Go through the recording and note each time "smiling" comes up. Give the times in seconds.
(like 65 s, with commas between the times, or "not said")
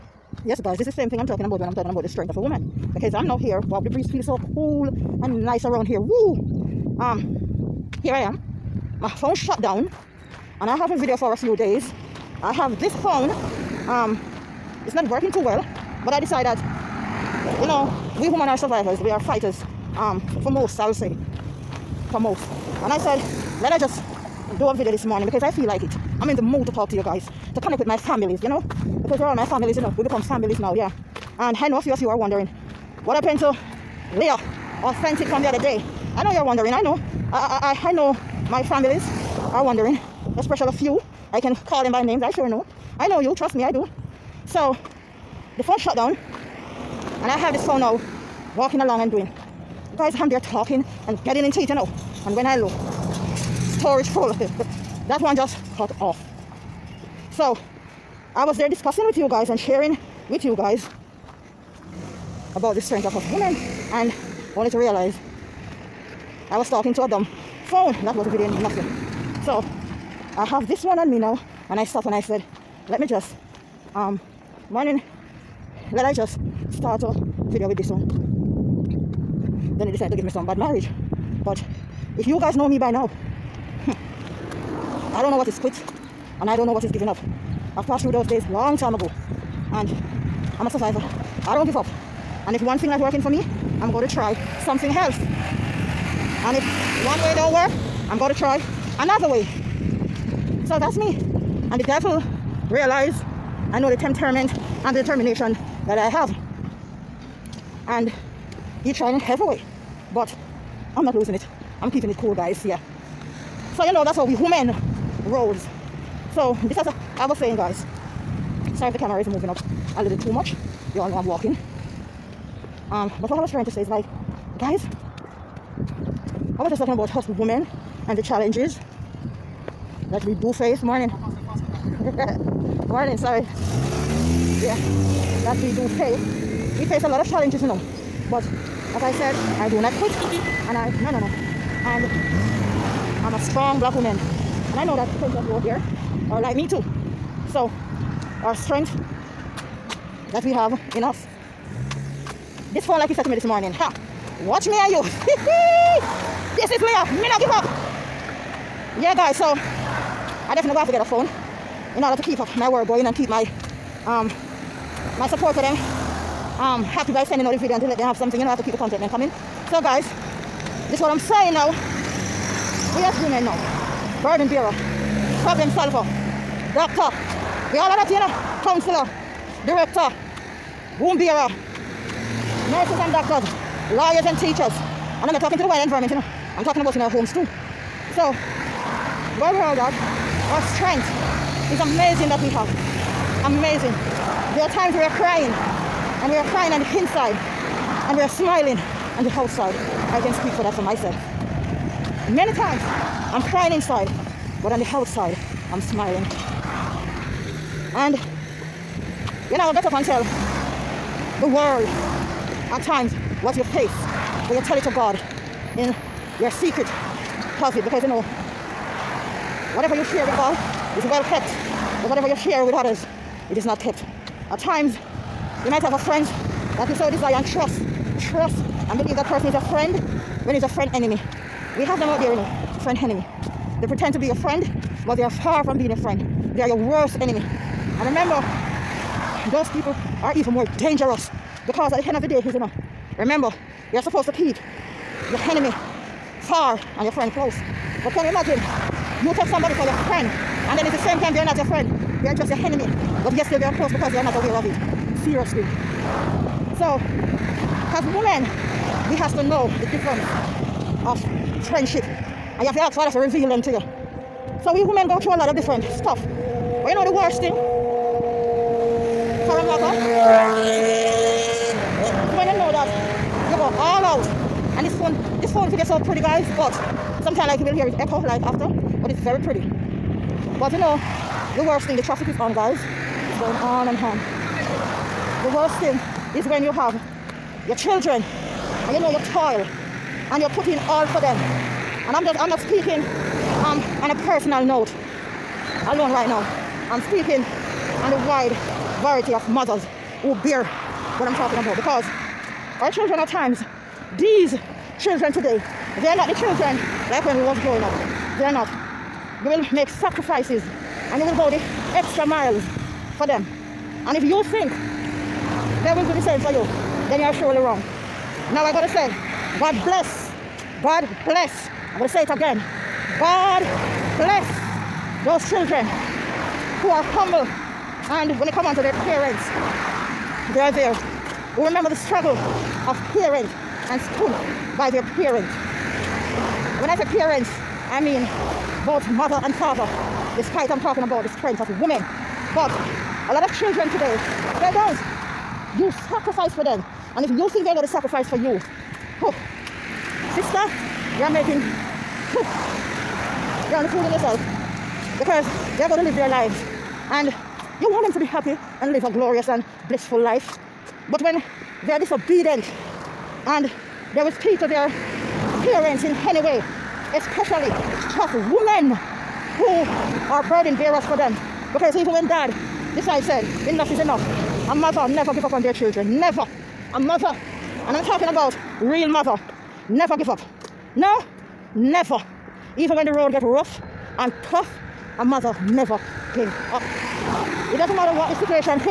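198 s, 205 s.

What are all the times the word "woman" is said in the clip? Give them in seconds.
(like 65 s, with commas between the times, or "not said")
2 s, 143 s.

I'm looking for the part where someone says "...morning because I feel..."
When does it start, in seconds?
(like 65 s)
25 s.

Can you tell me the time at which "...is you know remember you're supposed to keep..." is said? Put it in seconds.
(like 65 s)
242 s.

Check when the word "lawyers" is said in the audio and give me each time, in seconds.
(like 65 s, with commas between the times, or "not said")
183 s.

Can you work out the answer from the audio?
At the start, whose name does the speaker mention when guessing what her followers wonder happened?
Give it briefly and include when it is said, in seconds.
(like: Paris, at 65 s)
Leah, at 34 s.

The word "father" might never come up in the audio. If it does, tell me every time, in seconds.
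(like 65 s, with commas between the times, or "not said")
262 s, 339 s.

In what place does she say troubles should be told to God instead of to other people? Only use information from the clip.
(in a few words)
Secret closet.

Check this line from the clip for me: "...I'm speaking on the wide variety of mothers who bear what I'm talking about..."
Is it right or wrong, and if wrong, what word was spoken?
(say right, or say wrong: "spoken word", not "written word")
right.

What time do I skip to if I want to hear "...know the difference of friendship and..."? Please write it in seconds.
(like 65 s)
259 s.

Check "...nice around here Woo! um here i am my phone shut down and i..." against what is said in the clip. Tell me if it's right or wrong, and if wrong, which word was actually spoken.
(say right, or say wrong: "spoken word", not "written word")
right.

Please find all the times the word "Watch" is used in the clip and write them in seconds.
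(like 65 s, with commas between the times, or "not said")
154 s.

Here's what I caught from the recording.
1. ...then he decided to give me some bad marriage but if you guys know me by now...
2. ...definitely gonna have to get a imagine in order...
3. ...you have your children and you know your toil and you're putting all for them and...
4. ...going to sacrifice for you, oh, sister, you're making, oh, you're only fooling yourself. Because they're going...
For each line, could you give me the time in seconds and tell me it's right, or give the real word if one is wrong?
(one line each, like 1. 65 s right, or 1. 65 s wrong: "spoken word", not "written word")
1. 79 s right
2. 160 s wrong: "phone", not "imagine"
3. 286 s right
4. 347 s right.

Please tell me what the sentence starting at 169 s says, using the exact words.
So guys, this is what I'm saying now.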